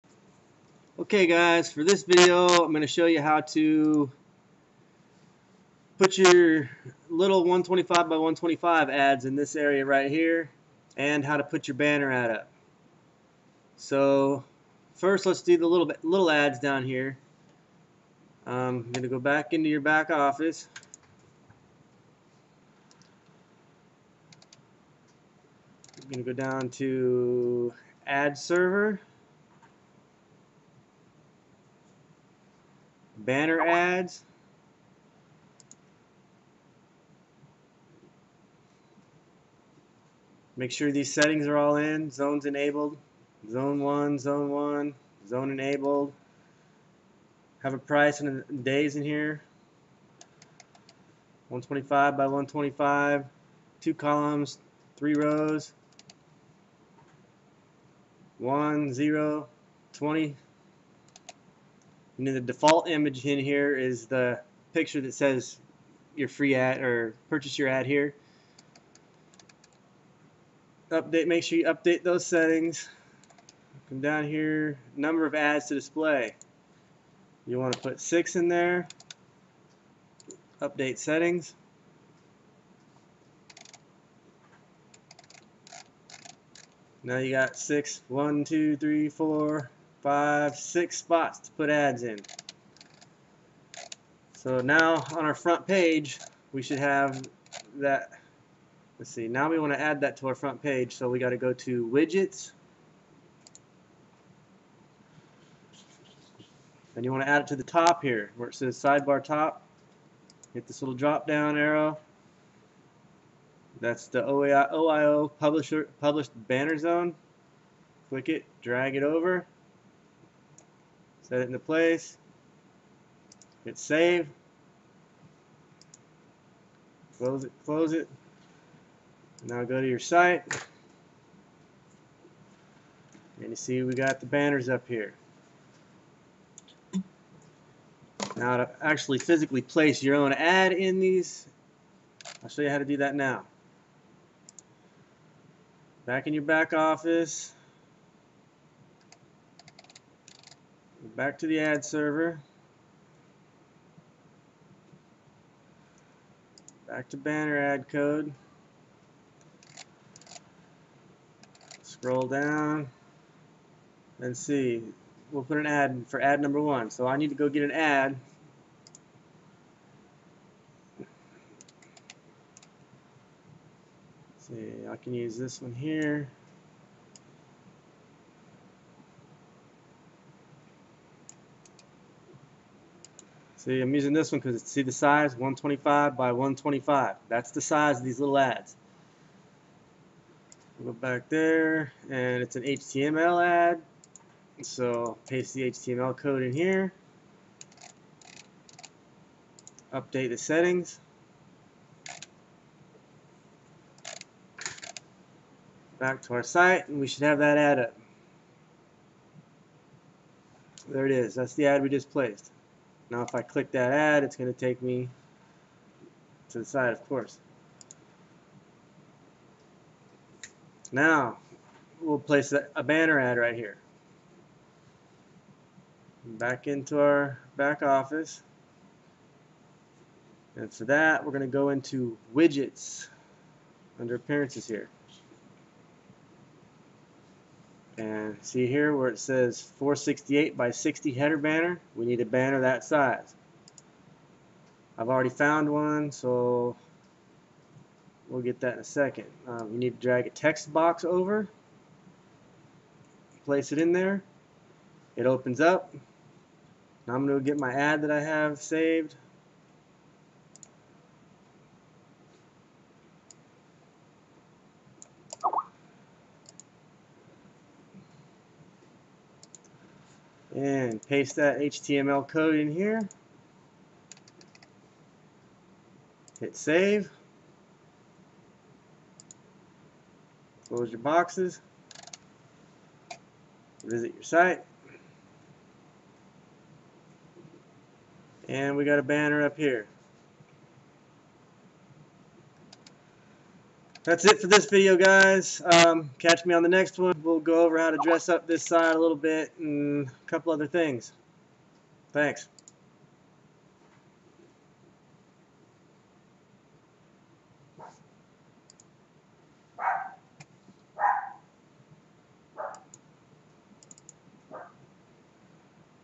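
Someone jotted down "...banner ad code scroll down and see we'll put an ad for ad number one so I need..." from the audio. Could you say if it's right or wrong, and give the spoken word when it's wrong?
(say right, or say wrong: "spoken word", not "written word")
right.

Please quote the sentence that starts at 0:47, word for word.
Have a price and days in here.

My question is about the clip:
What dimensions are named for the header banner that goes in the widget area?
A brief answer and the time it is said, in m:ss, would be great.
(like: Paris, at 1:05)
468 by 60, at 3:59.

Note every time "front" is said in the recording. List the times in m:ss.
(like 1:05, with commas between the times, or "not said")
1:35, 1:40.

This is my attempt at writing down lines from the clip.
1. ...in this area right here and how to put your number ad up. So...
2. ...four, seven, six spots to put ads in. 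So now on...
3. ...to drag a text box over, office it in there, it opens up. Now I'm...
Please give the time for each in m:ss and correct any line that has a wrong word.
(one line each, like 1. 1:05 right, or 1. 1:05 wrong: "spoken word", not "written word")
1. 0:09 wrong: "banner", not "number"
2. 1:29 wrong: "five", not "seven"
3. 4:10 wrong: "place", not "office".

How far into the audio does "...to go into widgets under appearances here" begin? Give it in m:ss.
3:51.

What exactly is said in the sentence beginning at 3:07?
That's the size of these little ads.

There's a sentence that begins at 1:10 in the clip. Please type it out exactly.
Update, make sure you update those settings.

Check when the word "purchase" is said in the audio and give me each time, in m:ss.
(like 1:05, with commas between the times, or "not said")
1:07.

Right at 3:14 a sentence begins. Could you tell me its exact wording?
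So paste the HTML code in here.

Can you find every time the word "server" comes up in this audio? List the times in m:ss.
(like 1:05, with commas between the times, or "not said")
0:28, 2:31.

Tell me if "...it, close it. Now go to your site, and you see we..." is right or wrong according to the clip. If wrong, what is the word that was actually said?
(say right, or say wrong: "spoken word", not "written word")
right.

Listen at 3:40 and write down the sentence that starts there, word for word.
Now, we'll place a banner ad right here.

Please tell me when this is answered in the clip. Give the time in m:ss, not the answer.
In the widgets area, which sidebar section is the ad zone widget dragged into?
1:48.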